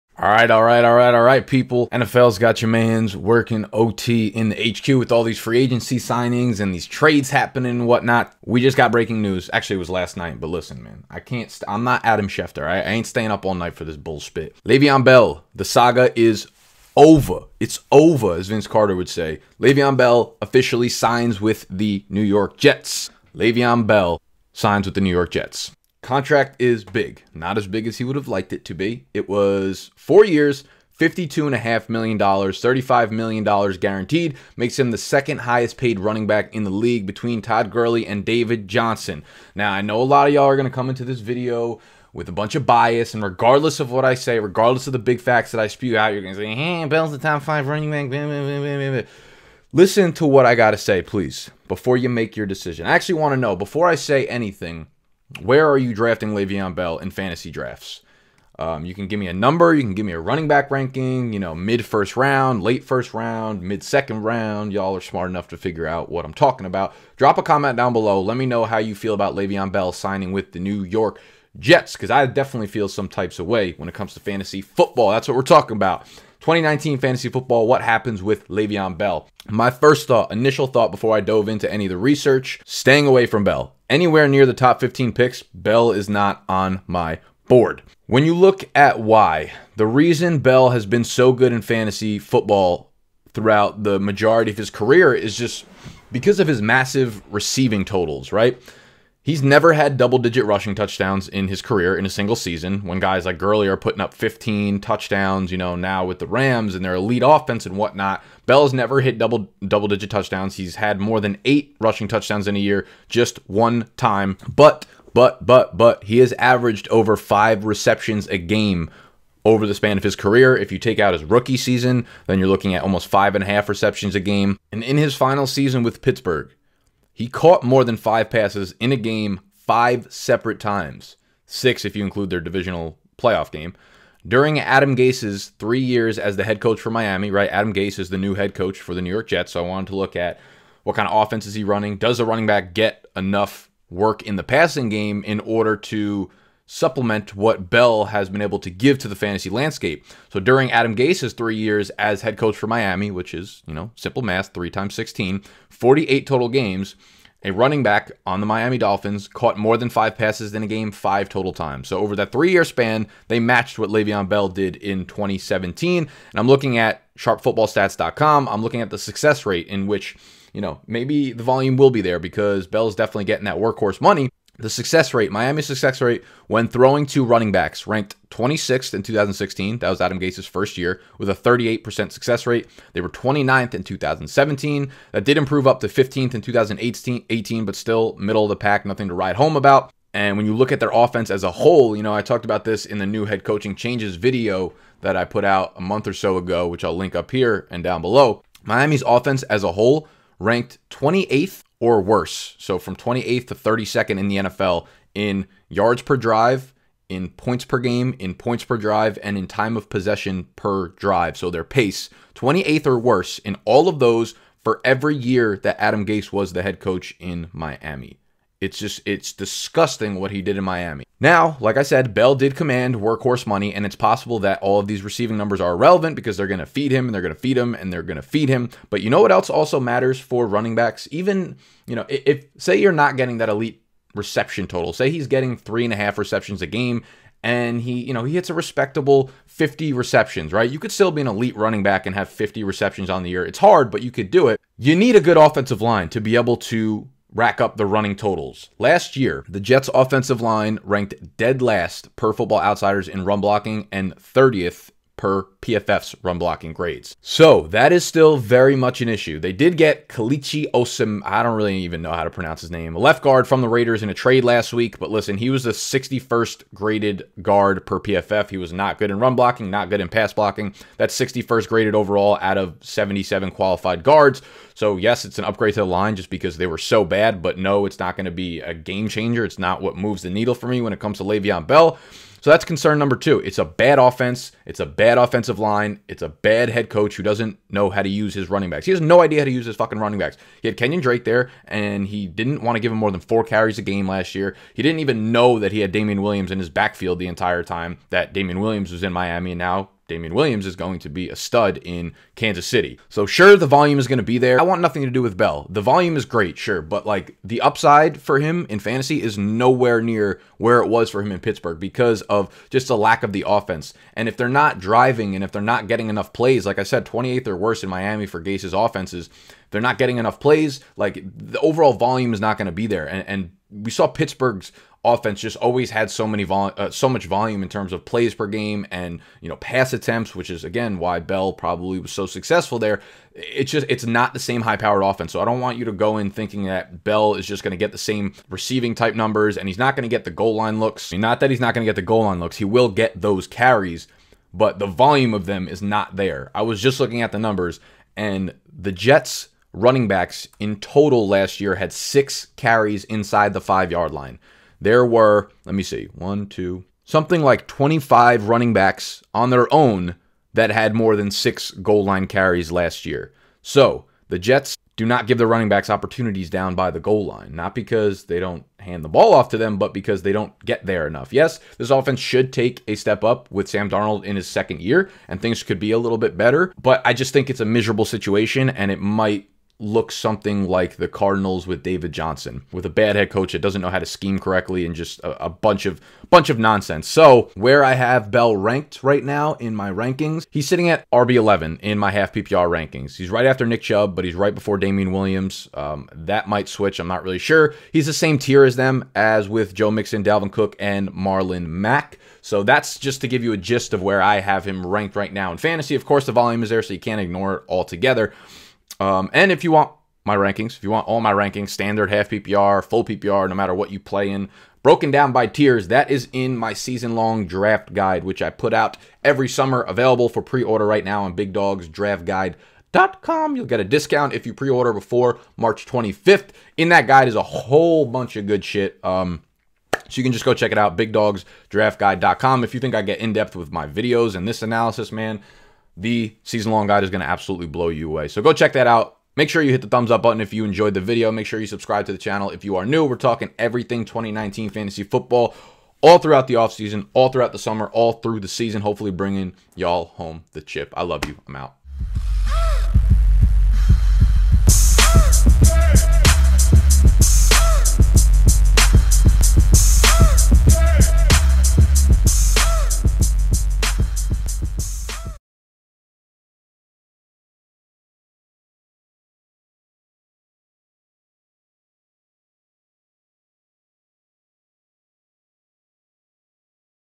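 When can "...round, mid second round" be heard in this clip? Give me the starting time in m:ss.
1:03.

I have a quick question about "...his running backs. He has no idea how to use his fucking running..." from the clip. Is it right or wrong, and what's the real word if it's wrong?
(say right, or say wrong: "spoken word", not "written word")
right.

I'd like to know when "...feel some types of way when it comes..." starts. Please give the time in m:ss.
1:12.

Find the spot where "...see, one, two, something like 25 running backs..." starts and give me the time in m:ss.
5:55.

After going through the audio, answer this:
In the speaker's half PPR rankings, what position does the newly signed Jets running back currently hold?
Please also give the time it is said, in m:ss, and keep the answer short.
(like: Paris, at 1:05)
RB11, at 6:31.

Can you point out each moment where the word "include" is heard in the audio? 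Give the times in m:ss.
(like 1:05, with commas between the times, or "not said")
2:12.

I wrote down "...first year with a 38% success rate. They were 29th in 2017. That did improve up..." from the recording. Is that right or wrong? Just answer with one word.
right.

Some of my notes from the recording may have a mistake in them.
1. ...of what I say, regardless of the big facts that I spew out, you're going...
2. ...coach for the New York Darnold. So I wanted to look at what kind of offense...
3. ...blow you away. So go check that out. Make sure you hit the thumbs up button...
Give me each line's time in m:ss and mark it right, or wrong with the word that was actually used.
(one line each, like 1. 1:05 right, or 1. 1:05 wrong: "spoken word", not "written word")
1. 0:43 right
2. 2:18 wrong: "Jets", not "Darnold"
3. 7:17 right.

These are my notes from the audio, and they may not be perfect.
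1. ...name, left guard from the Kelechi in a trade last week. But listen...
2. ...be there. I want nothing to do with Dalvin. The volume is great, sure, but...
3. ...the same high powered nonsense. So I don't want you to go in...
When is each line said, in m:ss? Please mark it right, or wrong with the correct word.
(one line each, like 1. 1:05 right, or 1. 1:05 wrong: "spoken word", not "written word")
1. 4:22 wrong: "Raiders", not "Kelechi"
2. 5:04 wrong: "Bell", not "Dalvin"
3. 5:34 wrong: "offense", not "nonsense".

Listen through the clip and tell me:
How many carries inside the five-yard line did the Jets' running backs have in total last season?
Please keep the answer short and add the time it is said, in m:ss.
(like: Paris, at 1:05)
6, at 5:51.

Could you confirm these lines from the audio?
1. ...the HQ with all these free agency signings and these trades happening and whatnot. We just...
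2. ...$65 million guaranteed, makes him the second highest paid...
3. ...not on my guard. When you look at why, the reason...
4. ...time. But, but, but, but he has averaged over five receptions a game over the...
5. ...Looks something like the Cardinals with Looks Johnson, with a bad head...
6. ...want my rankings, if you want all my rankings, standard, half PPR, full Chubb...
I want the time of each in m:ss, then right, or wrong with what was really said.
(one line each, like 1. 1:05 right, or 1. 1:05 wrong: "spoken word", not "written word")
1. 0:04 right
2. 0:32 wrong: "35", not "65"
3. 1:26 wrong: "board", not "guard"
4. 1:53 right
5. 6:19 wrong: "David", not "Looks"
6. 6:49 wrong: "PPR", not "Chubb".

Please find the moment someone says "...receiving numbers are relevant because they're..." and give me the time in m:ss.
3:45.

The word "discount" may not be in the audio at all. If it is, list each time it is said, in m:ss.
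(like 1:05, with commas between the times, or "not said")
7:03.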